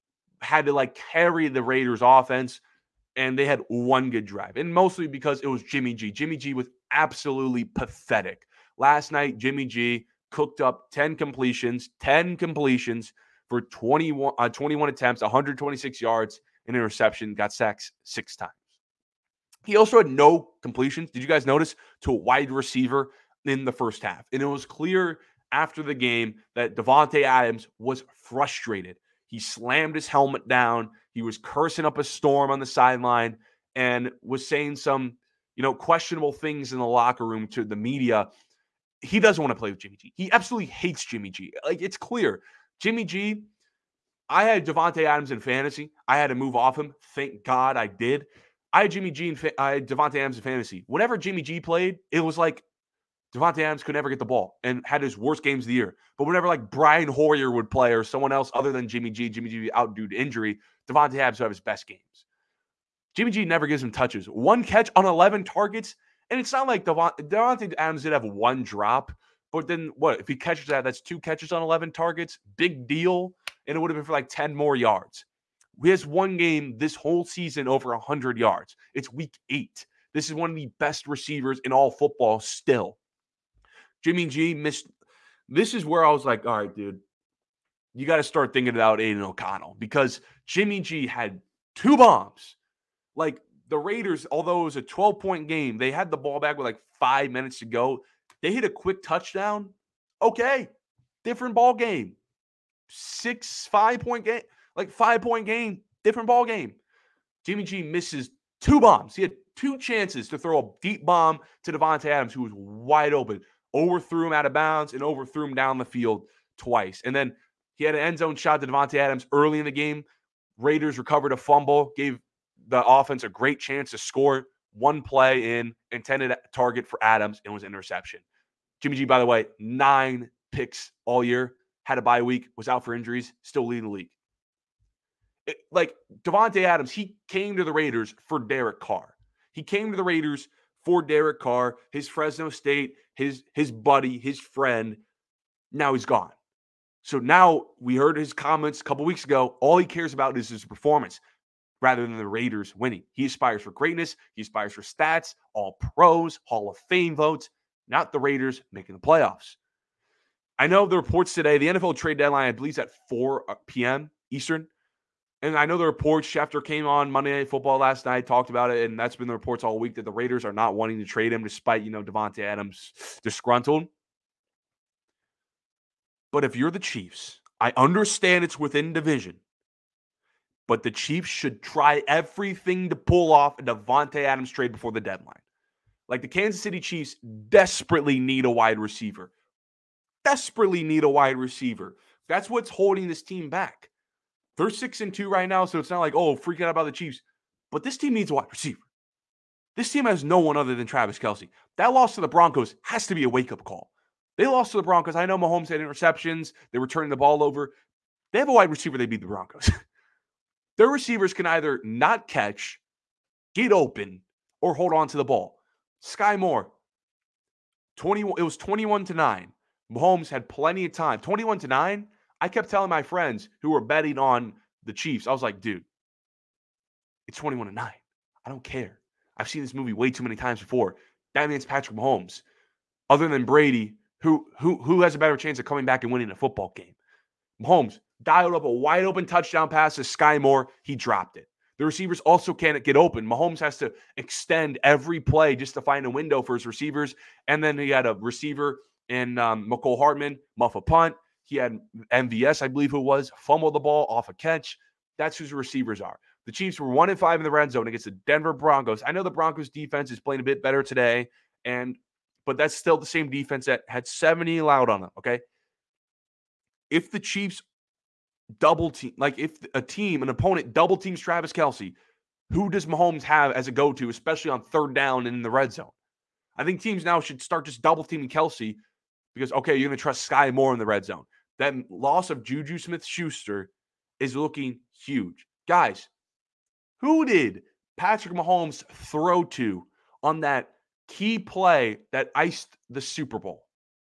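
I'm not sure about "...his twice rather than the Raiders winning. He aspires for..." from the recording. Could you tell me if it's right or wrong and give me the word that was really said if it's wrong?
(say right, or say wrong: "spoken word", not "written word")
wrong: "performance", not "twice".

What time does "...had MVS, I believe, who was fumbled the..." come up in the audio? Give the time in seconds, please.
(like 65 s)
251 s.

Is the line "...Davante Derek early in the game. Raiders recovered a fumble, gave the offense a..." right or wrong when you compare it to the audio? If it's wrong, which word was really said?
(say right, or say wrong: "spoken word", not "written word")
wrong: "Adams", not "Derek".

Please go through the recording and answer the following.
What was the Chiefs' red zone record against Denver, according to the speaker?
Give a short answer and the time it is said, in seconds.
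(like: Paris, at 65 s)
1 in 5, at 256 s.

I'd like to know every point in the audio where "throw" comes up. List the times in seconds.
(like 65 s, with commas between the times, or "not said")
110 s, 288 s.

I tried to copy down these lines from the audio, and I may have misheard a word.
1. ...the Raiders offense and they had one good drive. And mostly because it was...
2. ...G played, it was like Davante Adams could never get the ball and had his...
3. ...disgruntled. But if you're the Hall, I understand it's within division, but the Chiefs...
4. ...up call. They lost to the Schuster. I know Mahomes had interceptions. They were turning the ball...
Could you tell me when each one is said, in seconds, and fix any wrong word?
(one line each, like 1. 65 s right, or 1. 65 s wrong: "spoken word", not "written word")
1. 1 s right
2. 51 s right
3. 173 s wrong: "Chiefs", not "Hall"
4. 203 s wrong: "Broncos", not "Schuster".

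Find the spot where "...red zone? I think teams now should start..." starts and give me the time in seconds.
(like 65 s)
275 s.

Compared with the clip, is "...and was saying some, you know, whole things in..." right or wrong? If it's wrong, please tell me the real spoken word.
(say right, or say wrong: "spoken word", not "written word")
wrong: "questionable", not "whole".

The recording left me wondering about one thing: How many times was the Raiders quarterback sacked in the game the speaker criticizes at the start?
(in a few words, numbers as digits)
6.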